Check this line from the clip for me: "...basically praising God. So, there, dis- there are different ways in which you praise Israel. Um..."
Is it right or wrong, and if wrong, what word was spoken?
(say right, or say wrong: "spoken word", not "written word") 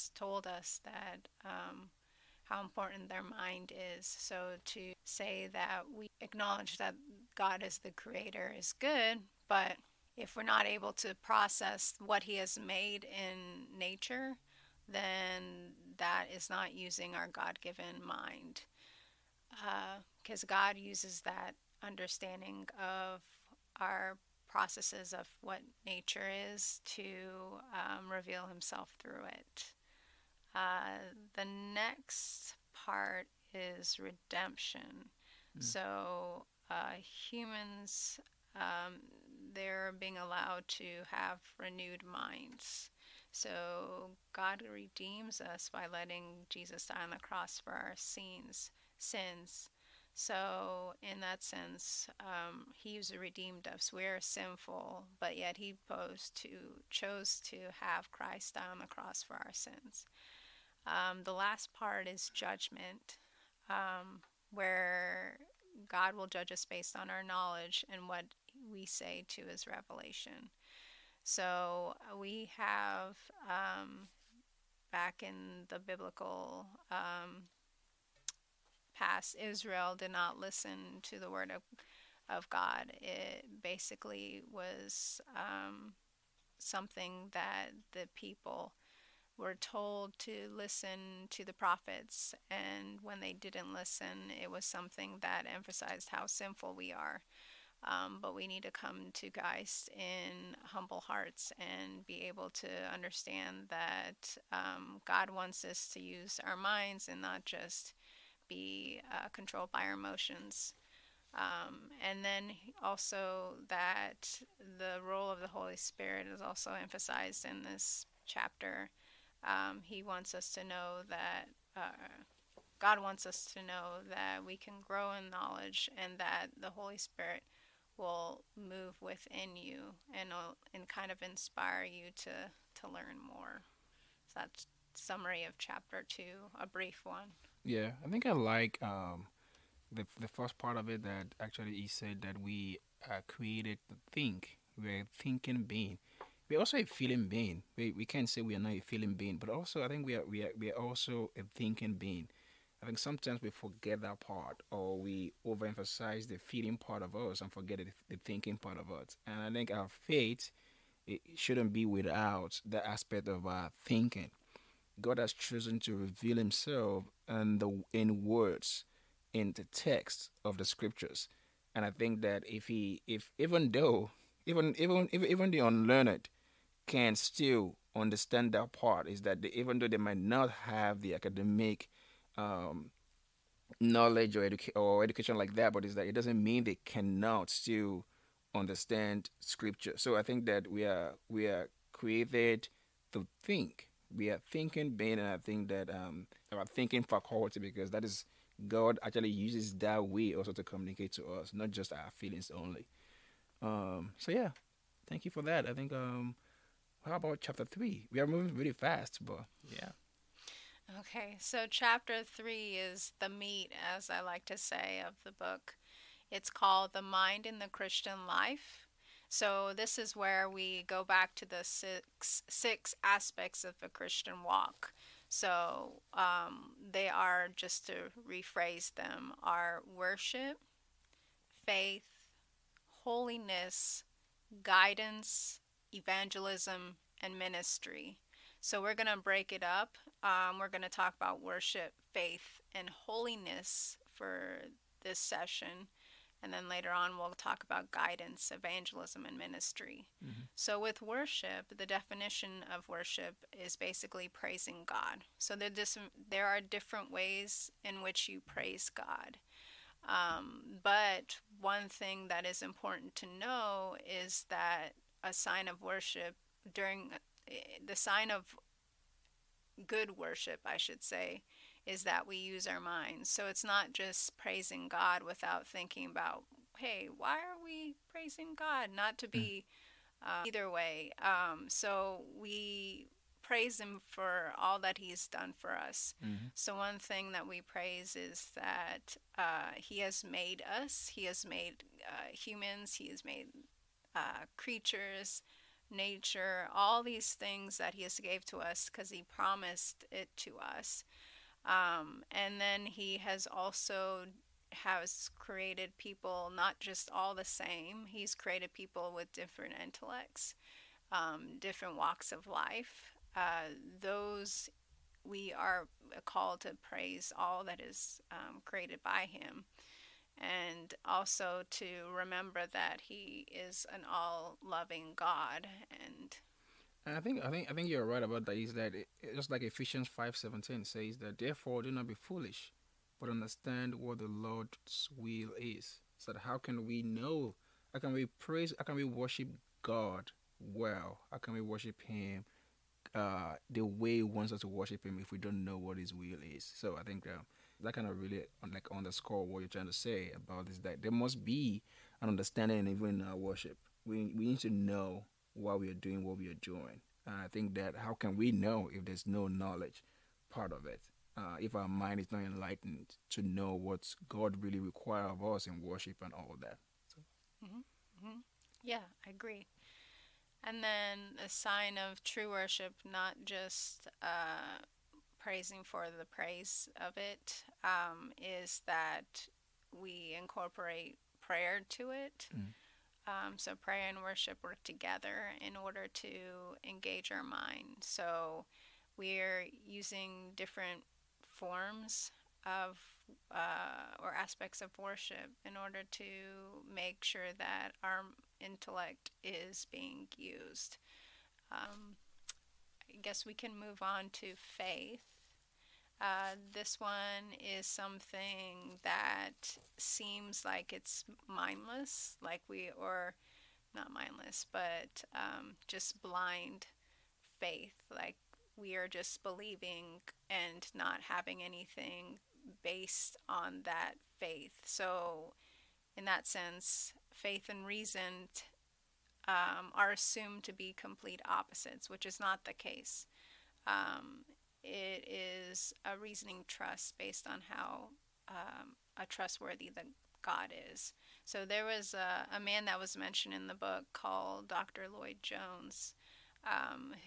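wrong: "God", not "Israel".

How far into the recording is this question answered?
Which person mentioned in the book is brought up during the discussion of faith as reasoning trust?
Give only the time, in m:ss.
7:24.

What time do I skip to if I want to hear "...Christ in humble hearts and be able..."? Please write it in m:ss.
1:39.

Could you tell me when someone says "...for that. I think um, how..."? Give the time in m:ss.
3:25.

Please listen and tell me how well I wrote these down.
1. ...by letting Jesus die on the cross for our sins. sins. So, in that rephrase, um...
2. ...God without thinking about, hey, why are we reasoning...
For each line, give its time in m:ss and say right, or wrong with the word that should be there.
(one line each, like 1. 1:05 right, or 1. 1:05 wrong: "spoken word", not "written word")
1. 0:45 wrong: "sense", not "rephrase"
2. 4:34 wrong: "praising", not "reasoning".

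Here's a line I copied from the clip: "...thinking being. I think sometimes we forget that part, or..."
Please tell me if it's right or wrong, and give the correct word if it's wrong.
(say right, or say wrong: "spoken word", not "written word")
right.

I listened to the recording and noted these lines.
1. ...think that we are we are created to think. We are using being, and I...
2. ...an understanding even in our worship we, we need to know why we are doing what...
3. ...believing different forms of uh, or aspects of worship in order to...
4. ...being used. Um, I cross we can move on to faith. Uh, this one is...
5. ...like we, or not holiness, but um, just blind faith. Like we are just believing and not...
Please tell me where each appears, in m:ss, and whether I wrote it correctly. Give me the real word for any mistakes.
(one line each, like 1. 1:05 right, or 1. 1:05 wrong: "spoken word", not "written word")
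1. 3:10 wrong: "thinking", not "using"
2. 5:52 right
3. 6:29 wrong: "using", not "believing"
4. 6:39 wrong: "guess", not "cross"
5. 6:52 wrong: "mindless", not "holiness".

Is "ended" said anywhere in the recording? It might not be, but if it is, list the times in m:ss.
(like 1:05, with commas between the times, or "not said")
not said.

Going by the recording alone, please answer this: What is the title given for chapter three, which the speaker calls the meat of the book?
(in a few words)
The Mind in the Christian Life.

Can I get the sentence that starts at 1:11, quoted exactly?
So uh, we have um, back in the biblical um, past, Israel did not listen to the word of, of God.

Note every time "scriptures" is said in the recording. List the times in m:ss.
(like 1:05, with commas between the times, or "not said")
2:50, 3:09.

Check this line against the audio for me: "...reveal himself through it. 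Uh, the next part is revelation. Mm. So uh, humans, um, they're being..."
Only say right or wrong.
wrong.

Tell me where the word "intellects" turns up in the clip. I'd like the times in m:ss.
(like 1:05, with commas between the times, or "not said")
5:09, 6:38.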